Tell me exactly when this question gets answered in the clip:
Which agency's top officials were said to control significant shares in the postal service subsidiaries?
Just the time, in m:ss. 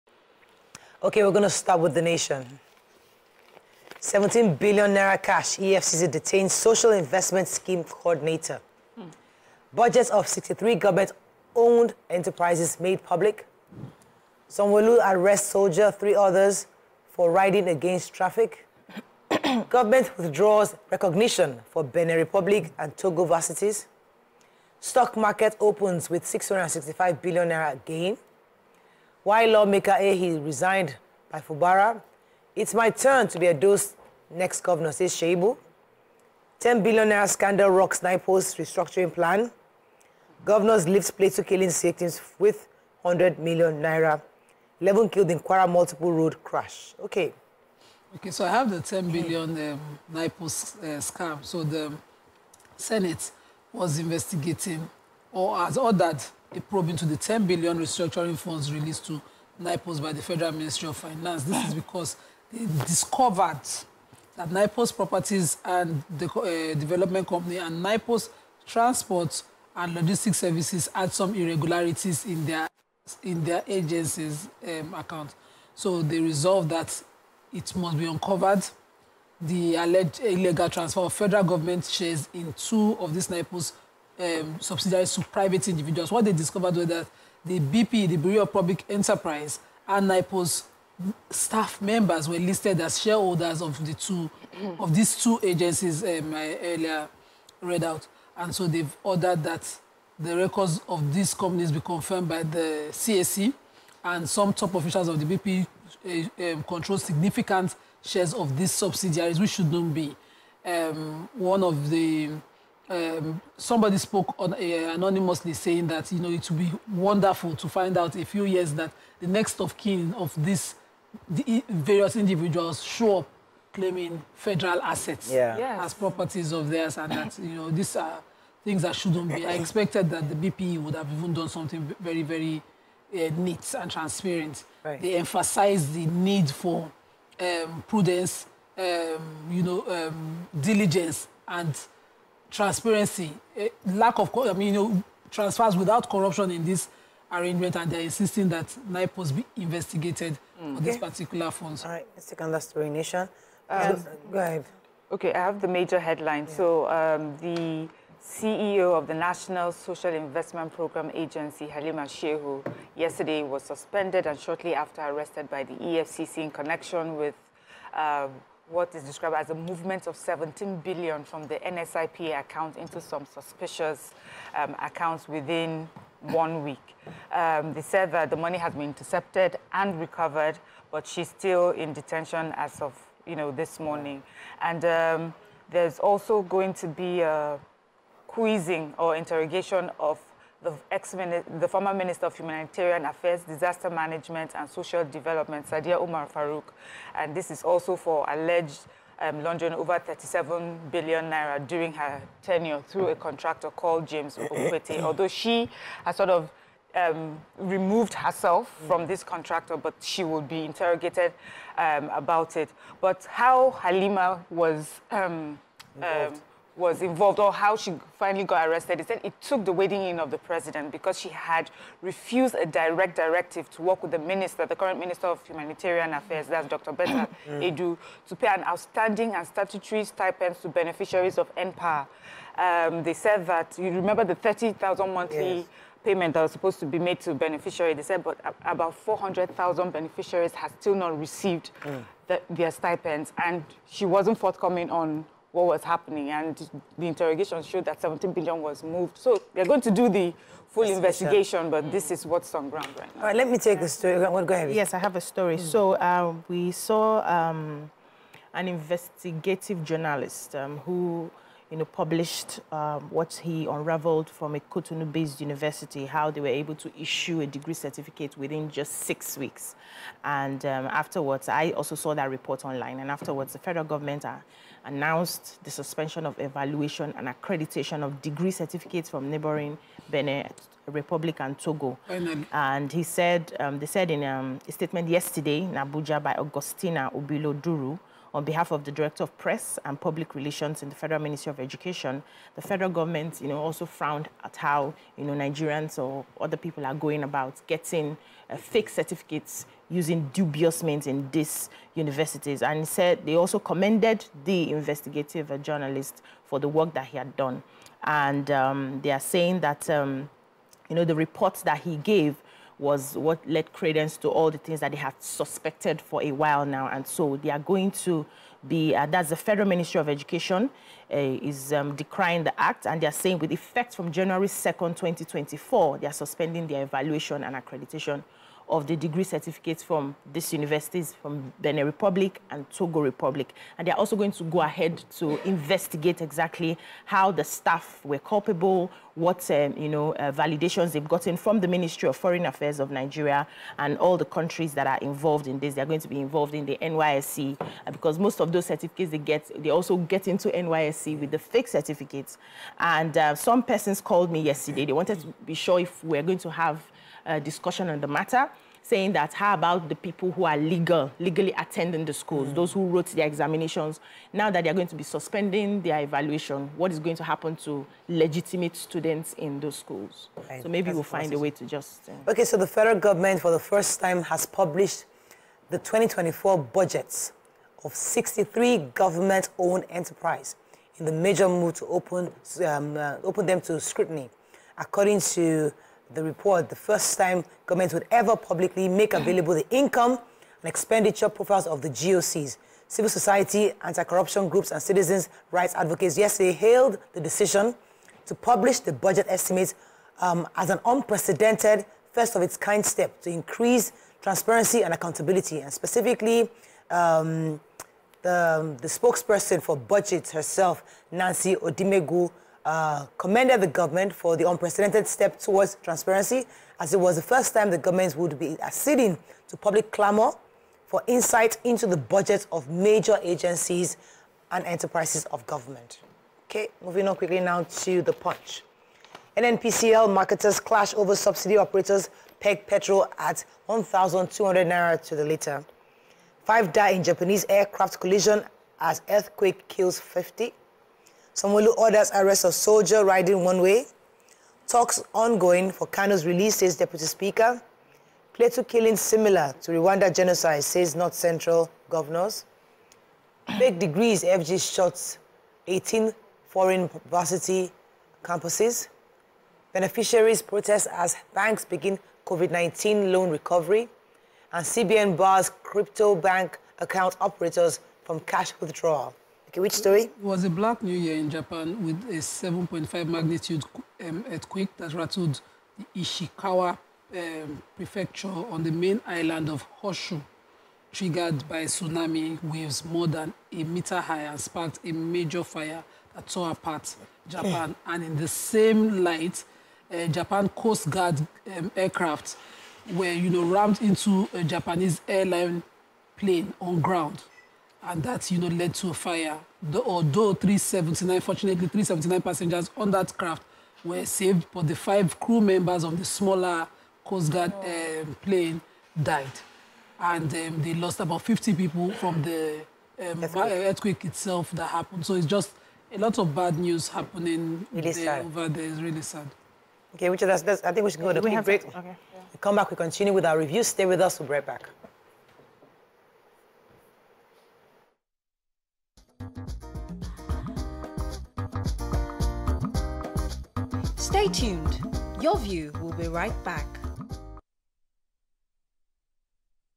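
1:28.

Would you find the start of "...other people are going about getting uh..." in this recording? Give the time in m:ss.
4:56.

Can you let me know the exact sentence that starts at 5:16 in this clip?
And so they are going to be, uh, that's the Federal Ministry of Education, uh, is um, decrying the act.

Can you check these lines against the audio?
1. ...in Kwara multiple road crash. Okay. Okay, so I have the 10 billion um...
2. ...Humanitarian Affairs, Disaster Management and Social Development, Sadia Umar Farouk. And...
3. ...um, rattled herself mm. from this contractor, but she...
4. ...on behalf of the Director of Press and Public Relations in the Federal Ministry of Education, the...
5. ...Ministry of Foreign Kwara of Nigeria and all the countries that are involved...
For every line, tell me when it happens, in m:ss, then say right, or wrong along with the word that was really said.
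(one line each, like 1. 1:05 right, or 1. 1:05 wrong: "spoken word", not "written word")
1. 0:45 right
2. 3:12 right
3. 3:26 wrong: "removed", not "rattled"
4. 4:48 right
5. 5:41 wrong: "Affairs", not "Kwara".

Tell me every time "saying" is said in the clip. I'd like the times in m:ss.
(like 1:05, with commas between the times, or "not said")
1:55, 5:09, 5:23, 5:58.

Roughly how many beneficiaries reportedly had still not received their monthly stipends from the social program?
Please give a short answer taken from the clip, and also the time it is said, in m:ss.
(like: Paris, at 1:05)
400,000, at 3:58.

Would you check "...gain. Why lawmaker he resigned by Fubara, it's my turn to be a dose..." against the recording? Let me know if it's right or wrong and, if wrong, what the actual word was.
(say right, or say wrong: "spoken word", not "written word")
right.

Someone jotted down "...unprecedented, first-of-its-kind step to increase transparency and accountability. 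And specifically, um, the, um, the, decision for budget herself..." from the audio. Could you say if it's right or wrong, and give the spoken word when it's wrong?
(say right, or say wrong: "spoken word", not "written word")
wrong: "spokesperson", not "decision".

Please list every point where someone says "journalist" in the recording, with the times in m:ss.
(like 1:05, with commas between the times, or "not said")
4:19, 5:05.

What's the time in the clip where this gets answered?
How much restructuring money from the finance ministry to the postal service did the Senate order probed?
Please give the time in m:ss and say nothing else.
0:57.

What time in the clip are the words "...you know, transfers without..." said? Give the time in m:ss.
2:24.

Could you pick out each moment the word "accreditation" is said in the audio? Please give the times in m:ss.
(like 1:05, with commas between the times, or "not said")
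4:37, 5:27.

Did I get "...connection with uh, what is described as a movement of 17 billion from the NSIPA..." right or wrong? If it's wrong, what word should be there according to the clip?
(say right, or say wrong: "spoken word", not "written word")
right.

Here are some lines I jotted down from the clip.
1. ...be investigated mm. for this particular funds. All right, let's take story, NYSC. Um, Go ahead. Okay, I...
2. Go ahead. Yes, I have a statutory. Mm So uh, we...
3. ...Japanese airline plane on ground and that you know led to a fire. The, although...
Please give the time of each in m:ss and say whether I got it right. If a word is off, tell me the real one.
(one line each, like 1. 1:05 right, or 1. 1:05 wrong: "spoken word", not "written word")
1. 2:29 wrong: "Nation", not "NYSC"
2. 4:14 wrong: "story", not "statutory"
3. 8:14 right.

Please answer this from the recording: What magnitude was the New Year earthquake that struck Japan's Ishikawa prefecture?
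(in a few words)
7.5.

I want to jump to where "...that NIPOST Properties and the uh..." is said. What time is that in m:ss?
1:04.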